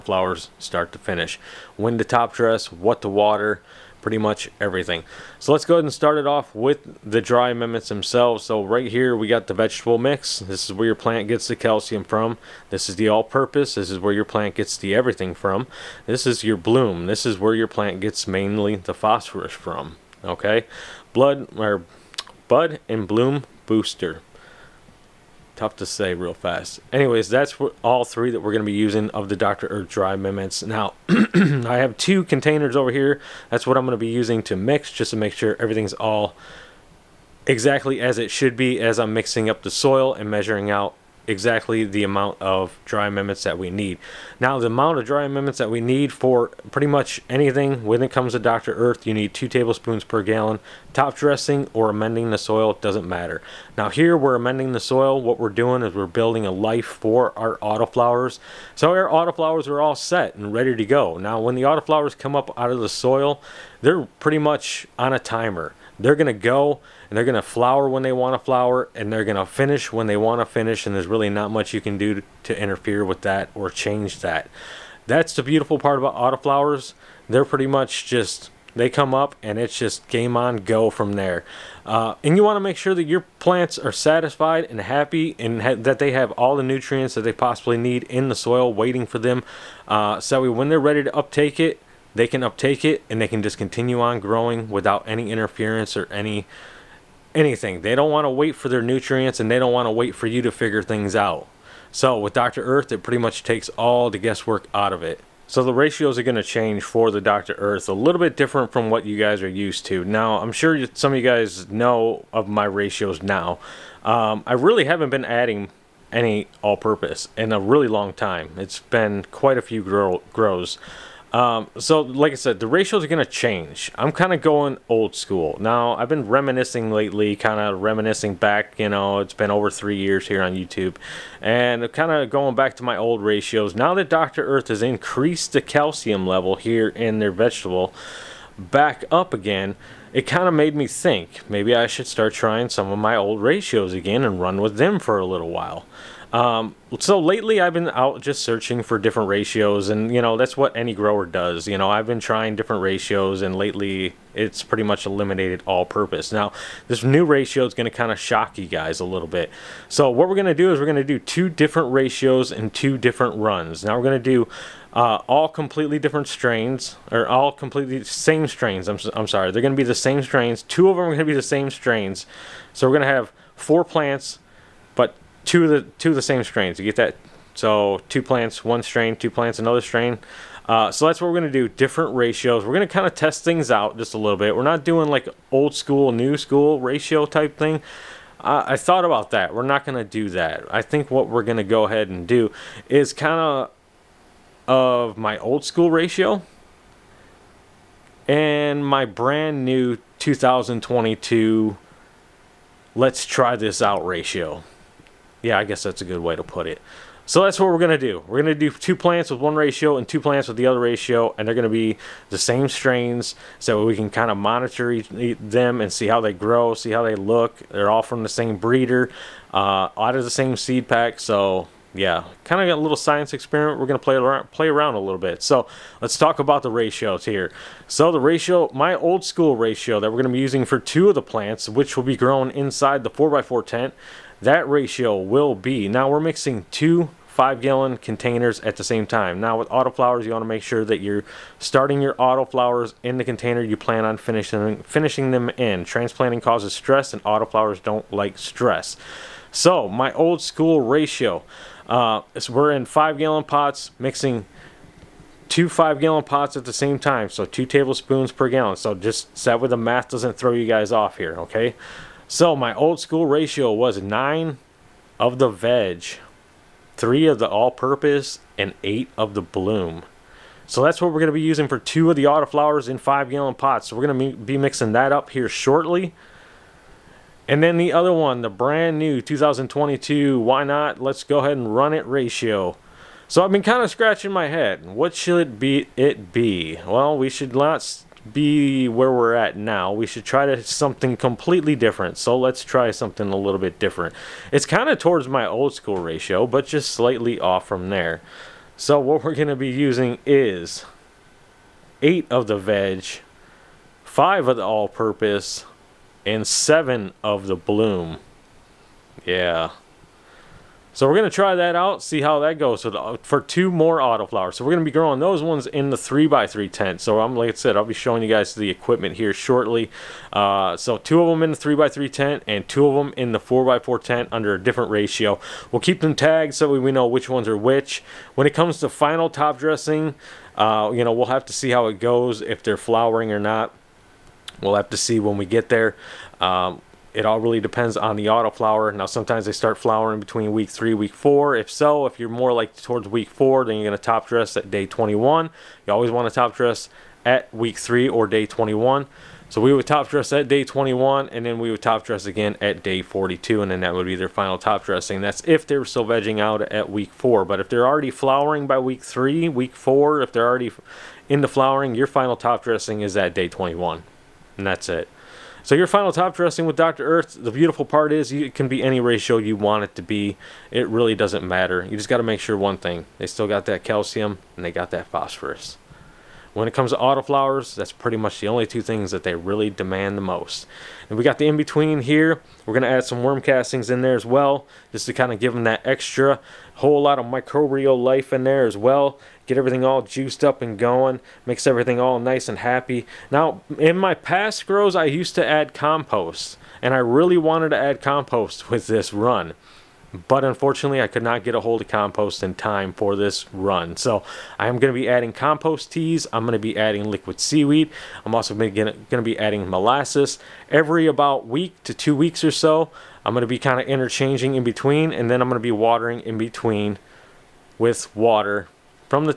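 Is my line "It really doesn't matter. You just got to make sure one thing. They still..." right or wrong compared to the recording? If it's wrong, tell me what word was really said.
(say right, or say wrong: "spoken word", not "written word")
right.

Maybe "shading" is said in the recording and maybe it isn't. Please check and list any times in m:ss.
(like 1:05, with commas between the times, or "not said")
not said.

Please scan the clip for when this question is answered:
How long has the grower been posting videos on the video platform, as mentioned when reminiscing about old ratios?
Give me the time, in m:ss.
2:09.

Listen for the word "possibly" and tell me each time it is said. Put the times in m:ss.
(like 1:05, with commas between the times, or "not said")
1:27.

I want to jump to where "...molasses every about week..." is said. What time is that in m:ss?
6:49.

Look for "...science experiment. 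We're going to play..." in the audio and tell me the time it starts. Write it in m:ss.
3:42.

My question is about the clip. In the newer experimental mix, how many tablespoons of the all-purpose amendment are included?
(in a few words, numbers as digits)
5.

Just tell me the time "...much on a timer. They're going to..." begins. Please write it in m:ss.
1:04.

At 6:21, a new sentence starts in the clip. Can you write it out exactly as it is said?
And we got the in-between here.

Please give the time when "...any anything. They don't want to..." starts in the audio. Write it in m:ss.
1:36.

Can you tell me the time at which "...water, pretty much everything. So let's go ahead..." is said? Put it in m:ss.
0:03.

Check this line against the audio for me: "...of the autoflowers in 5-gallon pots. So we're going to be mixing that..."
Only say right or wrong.
right.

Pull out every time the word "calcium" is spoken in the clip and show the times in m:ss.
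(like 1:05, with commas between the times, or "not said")
0:11, 2:15, 6:13.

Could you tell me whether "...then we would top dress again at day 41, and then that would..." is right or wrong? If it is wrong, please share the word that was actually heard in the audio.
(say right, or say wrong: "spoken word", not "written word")
wrong: "42", not "41".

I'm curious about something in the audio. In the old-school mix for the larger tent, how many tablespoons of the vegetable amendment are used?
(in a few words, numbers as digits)
9.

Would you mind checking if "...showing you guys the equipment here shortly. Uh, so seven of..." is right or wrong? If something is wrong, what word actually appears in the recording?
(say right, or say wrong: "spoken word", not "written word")
wrong: "two", not "seven".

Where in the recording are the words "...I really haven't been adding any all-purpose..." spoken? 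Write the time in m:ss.
1:54.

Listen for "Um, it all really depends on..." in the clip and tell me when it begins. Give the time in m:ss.
5:36.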